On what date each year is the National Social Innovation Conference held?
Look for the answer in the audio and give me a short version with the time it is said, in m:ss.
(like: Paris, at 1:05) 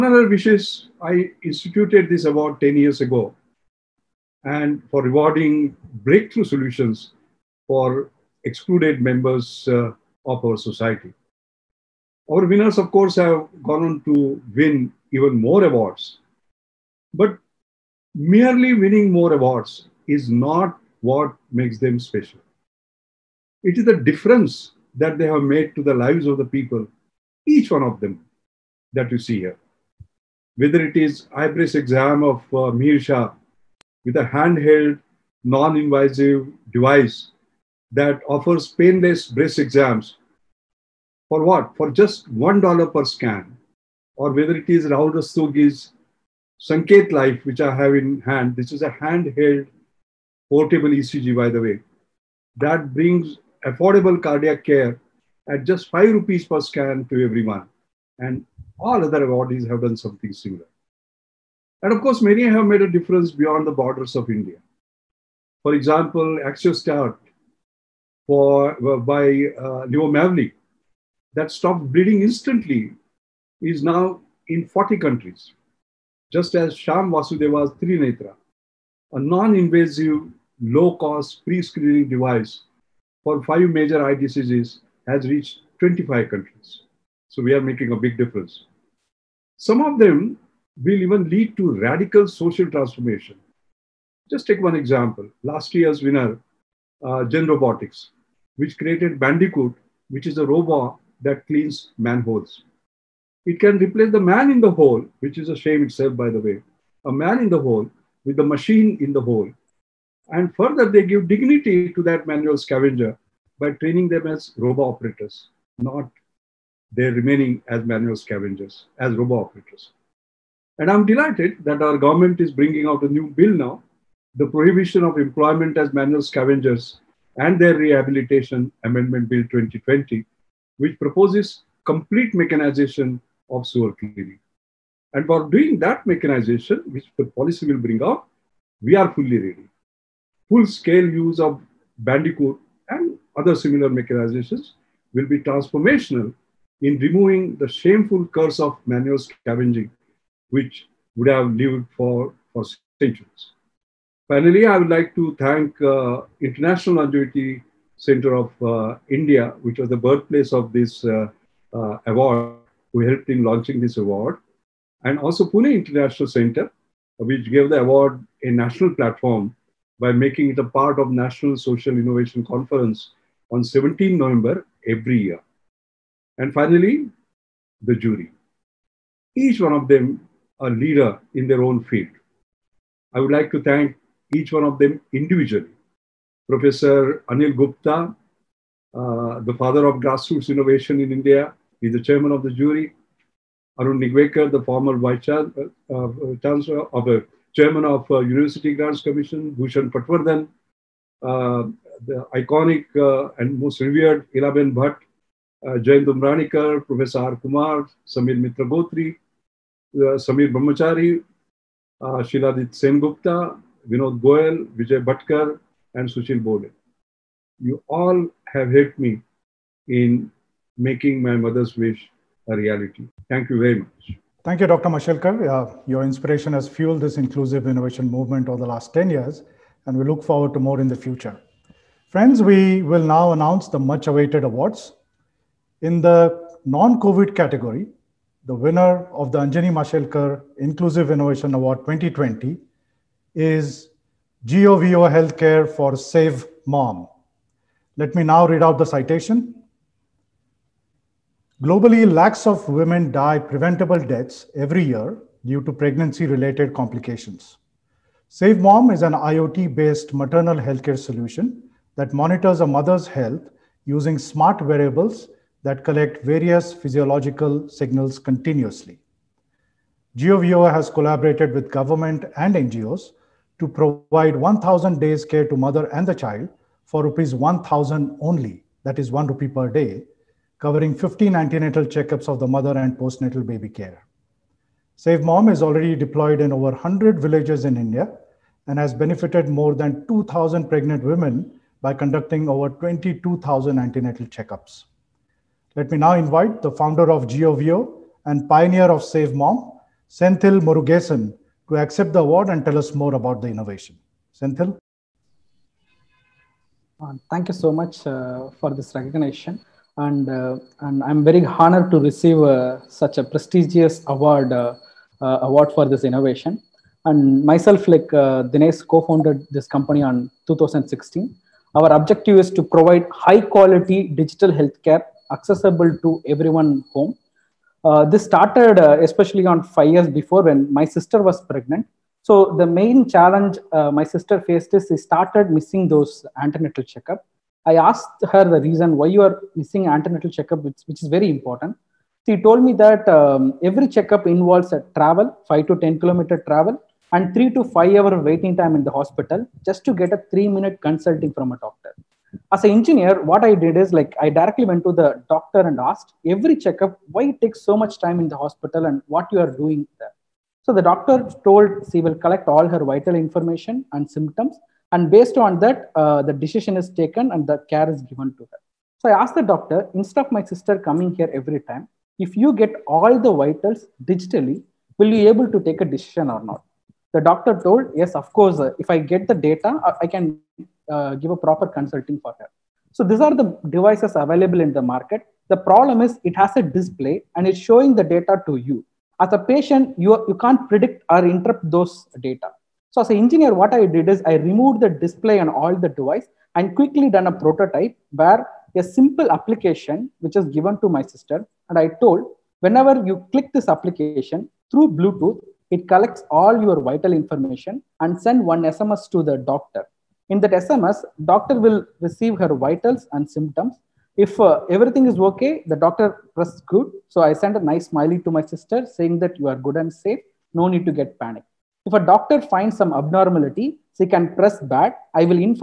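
17 November, at 2:53.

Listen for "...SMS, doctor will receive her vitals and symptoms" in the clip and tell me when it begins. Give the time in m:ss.
6:50.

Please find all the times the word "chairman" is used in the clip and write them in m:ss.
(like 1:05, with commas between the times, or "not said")
3:12, 3:17.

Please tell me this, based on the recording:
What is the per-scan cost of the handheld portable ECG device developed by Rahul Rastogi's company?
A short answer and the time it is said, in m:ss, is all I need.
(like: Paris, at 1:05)
5 rupees, at 0:55.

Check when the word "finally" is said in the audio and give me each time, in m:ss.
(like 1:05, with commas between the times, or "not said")
2:34, 2:56.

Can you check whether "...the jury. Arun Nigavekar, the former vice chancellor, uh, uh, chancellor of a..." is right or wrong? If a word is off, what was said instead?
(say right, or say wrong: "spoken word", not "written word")
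right.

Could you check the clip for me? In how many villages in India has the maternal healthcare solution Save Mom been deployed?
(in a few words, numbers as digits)
over 100.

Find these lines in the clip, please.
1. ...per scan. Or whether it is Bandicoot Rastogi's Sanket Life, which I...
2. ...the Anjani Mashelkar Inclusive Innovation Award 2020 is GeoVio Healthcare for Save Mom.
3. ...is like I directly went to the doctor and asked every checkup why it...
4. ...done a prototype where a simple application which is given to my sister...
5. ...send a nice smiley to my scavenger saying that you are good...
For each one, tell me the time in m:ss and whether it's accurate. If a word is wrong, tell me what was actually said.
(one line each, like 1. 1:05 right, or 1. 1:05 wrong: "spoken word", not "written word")
1. 0:42 wrong: "Rahul", not "Bandicoot"
2. 3:59 right
3. 5:53 right
4. 6:37 right
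5. 6:57 wrong: "sister", not "scavenger".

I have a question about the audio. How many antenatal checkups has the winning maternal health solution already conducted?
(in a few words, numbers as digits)
over 22,000.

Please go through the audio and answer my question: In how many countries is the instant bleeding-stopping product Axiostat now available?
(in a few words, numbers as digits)
40.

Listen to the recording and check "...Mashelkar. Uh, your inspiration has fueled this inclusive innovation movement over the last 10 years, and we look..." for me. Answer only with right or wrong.
right.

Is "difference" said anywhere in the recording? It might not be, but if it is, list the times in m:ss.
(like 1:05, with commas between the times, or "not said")
0:23, 1:02, 1:28.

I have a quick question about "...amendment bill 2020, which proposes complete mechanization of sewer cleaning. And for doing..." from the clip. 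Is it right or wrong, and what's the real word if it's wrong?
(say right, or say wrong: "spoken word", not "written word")
right.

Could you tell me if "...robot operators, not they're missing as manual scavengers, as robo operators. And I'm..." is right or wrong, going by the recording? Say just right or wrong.
wrong.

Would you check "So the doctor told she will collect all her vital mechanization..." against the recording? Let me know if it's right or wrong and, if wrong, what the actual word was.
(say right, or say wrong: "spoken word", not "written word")
wrong: "information", not "mechanization".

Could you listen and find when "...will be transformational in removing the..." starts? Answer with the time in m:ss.
2:25.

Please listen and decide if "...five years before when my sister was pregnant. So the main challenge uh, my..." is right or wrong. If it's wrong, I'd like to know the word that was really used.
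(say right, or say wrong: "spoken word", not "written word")
right.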